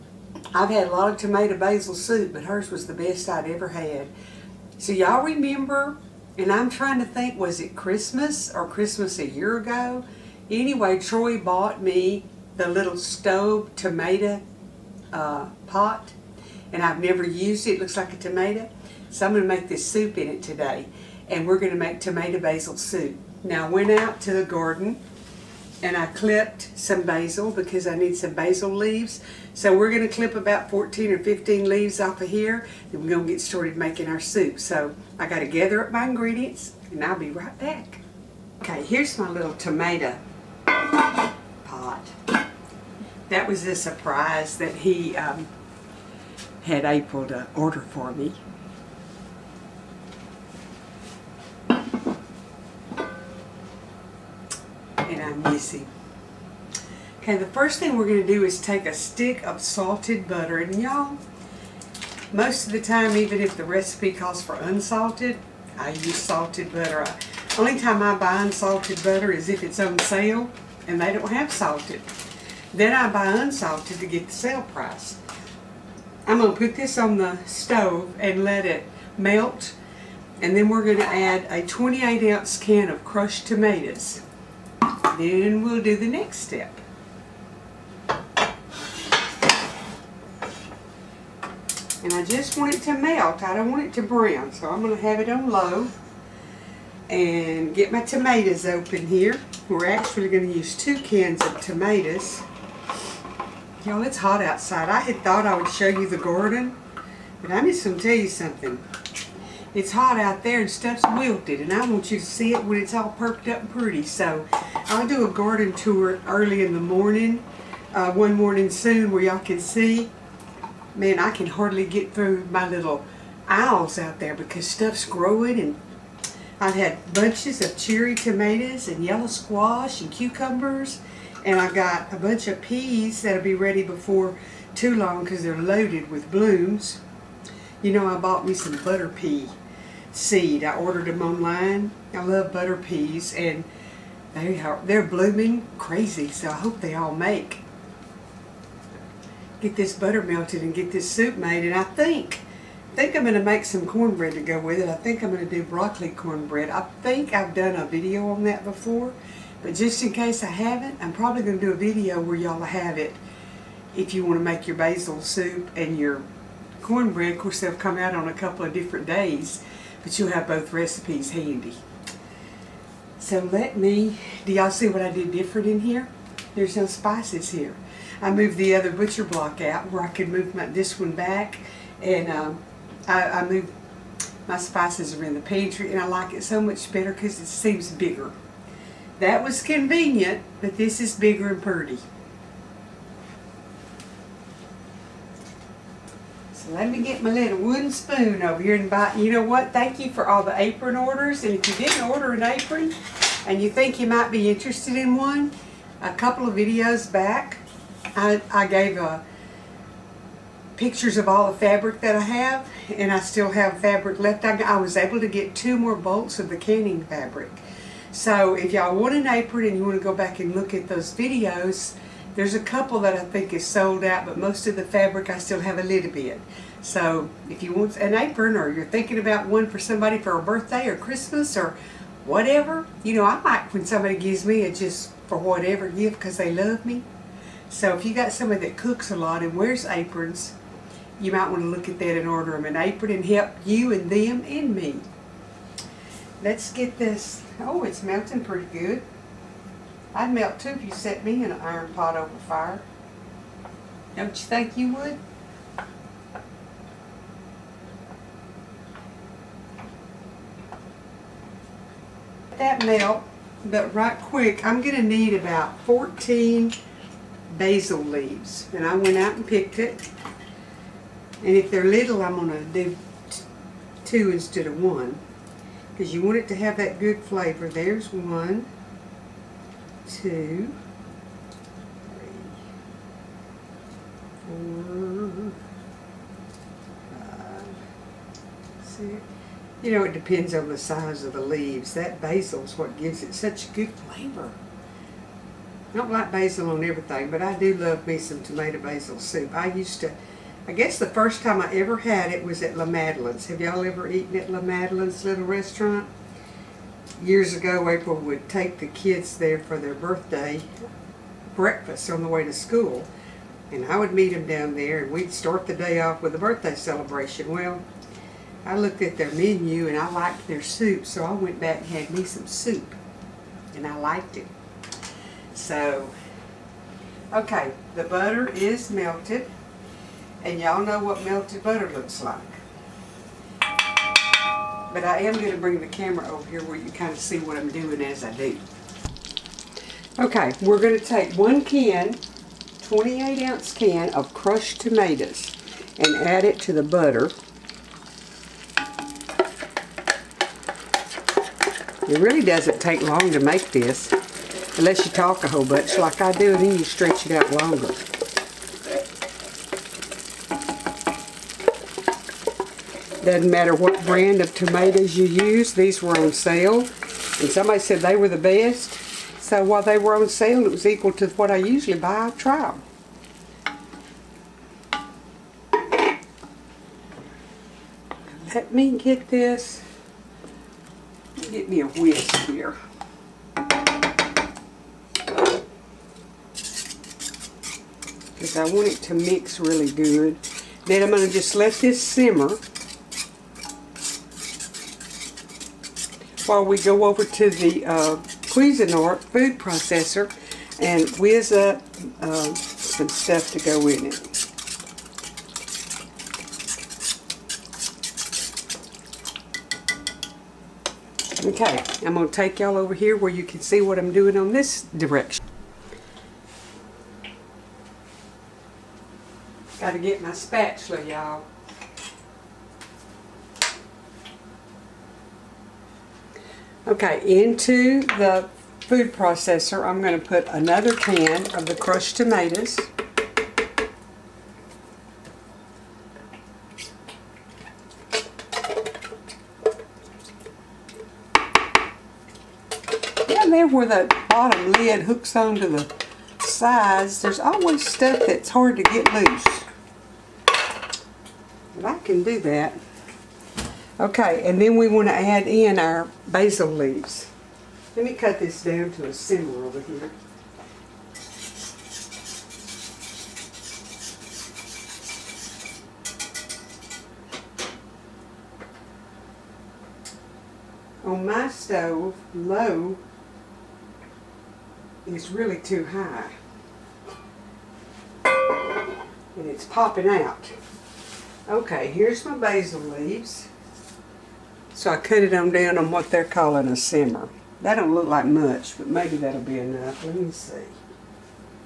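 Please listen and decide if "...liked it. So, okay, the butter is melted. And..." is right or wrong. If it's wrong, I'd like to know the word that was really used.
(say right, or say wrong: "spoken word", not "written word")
right.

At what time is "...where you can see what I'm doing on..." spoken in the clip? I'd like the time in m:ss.
6:53.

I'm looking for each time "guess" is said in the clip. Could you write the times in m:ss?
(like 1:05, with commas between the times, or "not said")
5:00.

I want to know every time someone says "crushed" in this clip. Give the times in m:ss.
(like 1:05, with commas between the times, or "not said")
1:23, 5:44, 7:11.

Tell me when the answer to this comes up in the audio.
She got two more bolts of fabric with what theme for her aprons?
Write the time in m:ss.
3:36.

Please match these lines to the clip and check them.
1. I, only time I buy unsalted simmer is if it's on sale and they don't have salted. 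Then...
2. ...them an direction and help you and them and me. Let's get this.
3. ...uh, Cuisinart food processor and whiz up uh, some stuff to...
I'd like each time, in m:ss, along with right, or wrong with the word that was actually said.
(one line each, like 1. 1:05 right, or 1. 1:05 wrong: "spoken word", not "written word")
1. 1:07 wrong: "butter", not "simmer"
2. 4:02 wrong: "apron", not "direction"
3. 6:37 right.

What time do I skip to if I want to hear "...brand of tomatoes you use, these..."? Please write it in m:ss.
6:04.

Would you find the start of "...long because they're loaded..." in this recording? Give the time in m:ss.
2:14.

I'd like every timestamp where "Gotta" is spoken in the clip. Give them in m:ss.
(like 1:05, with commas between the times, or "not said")
6:59.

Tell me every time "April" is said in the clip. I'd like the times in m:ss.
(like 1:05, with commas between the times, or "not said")
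0:46, 5:07.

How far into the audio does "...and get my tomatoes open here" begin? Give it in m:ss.
1:37.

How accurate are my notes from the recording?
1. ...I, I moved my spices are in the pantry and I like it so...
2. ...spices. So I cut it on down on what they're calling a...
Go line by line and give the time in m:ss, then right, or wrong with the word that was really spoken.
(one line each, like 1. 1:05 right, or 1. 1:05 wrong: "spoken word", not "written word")
1. 3:03 right
2. 8:02 wrong: "leaves", not "spices".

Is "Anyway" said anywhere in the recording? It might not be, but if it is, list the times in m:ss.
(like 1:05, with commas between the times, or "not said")
0:10.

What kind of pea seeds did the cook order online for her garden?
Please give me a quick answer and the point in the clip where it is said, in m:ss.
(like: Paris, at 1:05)
butter pea, at 2:18.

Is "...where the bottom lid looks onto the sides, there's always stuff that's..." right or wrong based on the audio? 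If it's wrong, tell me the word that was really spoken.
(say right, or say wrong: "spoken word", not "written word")
wrong: "hooks", not "looks".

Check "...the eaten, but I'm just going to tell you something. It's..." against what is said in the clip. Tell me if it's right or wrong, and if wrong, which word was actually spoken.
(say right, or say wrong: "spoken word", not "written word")
wrong: "garden", not "eaten".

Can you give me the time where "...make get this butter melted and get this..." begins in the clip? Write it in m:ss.
2:27.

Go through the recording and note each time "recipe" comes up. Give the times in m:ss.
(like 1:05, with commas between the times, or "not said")
1:03, 2:50.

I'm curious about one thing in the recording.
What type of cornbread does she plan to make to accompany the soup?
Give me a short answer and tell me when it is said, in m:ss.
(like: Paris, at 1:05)
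broccoli cornbread, at 2:35.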